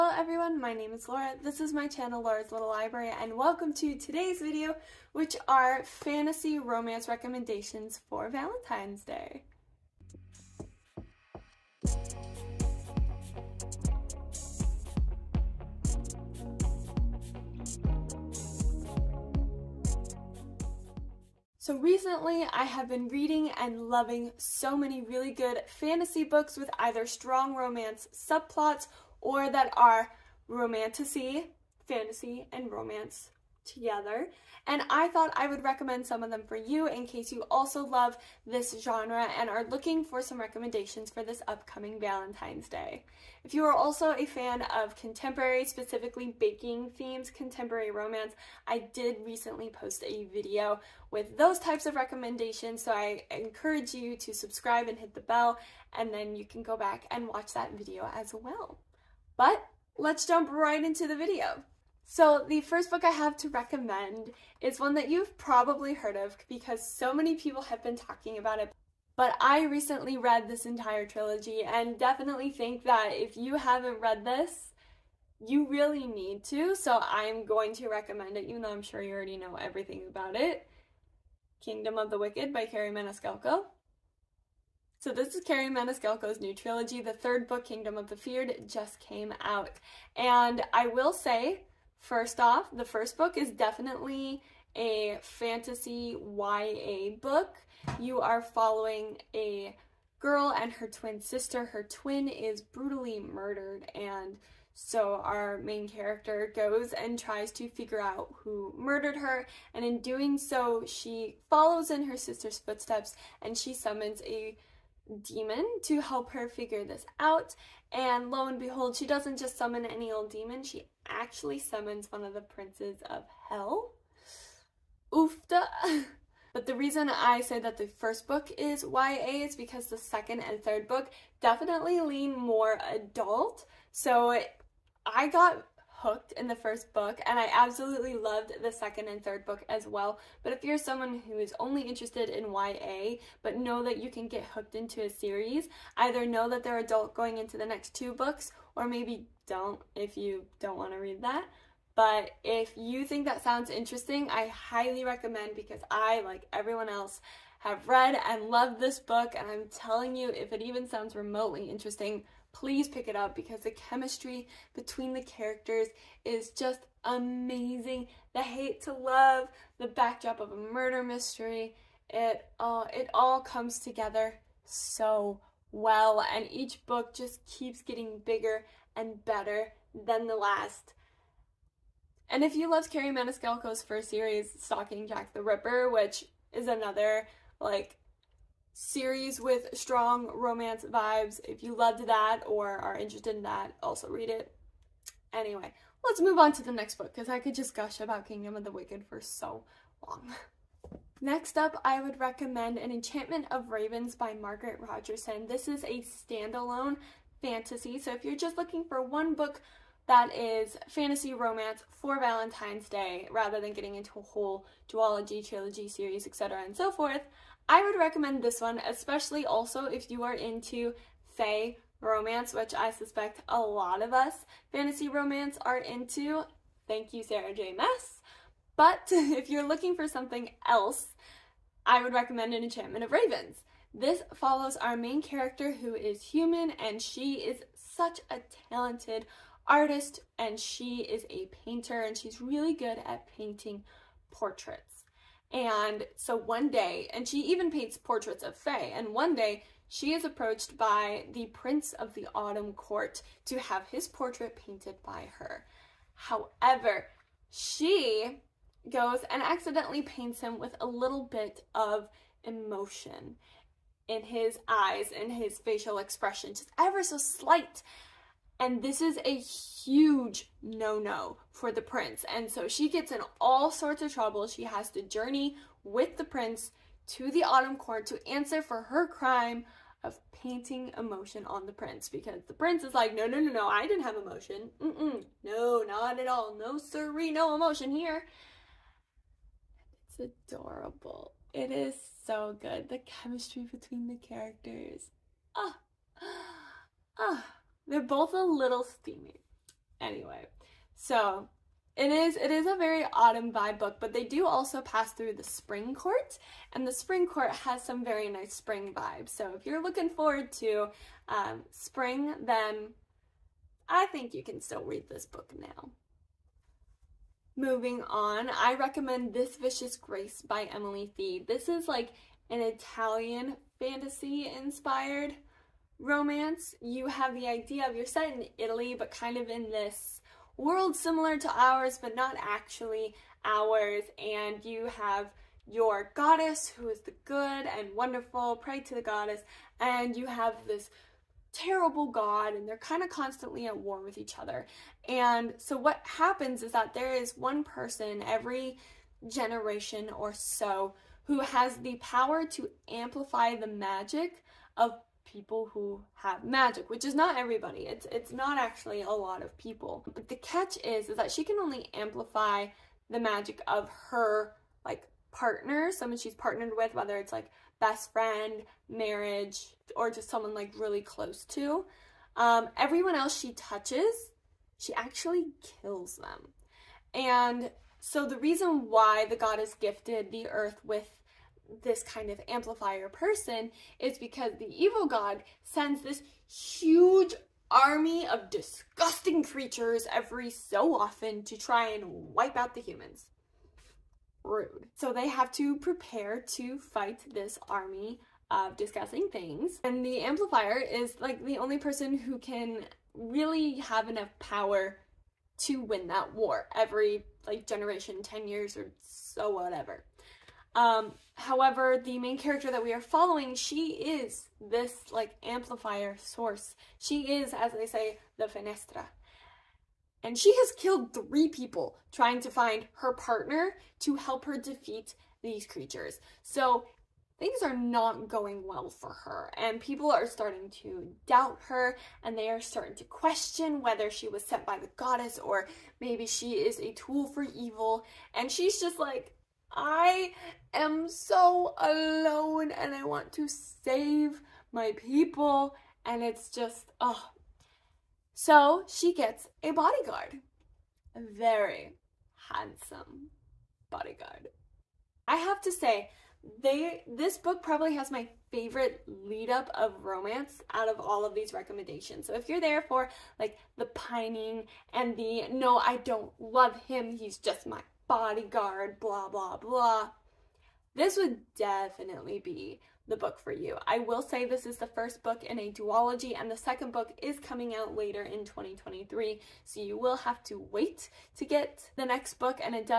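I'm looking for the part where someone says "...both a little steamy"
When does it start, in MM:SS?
04:58.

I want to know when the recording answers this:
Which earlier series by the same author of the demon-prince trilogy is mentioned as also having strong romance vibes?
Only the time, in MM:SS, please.
03:04.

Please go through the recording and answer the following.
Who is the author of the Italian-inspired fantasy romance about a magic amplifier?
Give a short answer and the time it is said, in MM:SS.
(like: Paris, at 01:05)
Emily Thiede, at 05:20.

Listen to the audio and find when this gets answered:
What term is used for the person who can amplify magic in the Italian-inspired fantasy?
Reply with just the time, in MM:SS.
06:58.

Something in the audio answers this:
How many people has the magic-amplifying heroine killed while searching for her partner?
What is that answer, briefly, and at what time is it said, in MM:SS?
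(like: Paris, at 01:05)
3, at 07:01.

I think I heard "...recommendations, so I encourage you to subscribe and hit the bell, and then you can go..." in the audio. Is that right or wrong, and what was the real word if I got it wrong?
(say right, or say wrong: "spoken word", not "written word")
right.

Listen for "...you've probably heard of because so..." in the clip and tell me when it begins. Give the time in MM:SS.
01:05.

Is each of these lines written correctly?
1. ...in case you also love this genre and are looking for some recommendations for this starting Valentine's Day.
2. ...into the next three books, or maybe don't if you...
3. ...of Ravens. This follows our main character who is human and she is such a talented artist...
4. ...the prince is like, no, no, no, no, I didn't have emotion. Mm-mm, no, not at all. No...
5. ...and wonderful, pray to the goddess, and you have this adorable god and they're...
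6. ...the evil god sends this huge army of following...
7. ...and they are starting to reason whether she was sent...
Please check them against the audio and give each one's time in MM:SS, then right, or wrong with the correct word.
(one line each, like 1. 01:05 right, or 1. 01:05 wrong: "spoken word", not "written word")
1. 00:36 wrong: "upcoming", not "starting"
2. 02:27 wrong: "two", not "three"
3. 03:53 right
4. 04:42 right
5. 05:37 wrong: "terrible", not "adorable"
6. 06:24 wrong: "disgusting", not "following"
7. 07:12 wrong: "question", not "reason".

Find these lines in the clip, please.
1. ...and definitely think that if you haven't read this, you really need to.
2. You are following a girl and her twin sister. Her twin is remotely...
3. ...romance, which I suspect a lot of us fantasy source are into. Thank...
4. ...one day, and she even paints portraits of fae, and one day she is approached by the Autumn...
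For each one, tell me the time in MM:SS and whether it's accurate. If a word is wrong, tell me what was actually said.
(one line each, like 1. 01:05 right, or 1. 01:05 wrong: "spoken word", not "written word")
1. 01:11 right
2. 01:37 wrong: "brutally", not "remotely"
3. 03:42 wrong: "romance", not "source"
4. 04:06 wrong: "Prince", not "Autumn".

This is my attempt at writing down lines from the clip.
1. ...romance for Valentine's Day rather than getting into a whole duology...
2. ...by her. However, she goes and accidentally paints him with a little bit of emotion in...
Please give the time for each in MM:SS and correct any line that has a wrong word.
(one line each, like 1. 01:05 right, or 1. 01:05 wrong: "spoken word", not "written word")
1. 03:31 right
2. 04:15 right.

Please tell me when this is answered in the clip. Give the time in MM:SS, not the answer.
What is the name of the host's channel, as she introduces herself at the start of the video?
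00:02.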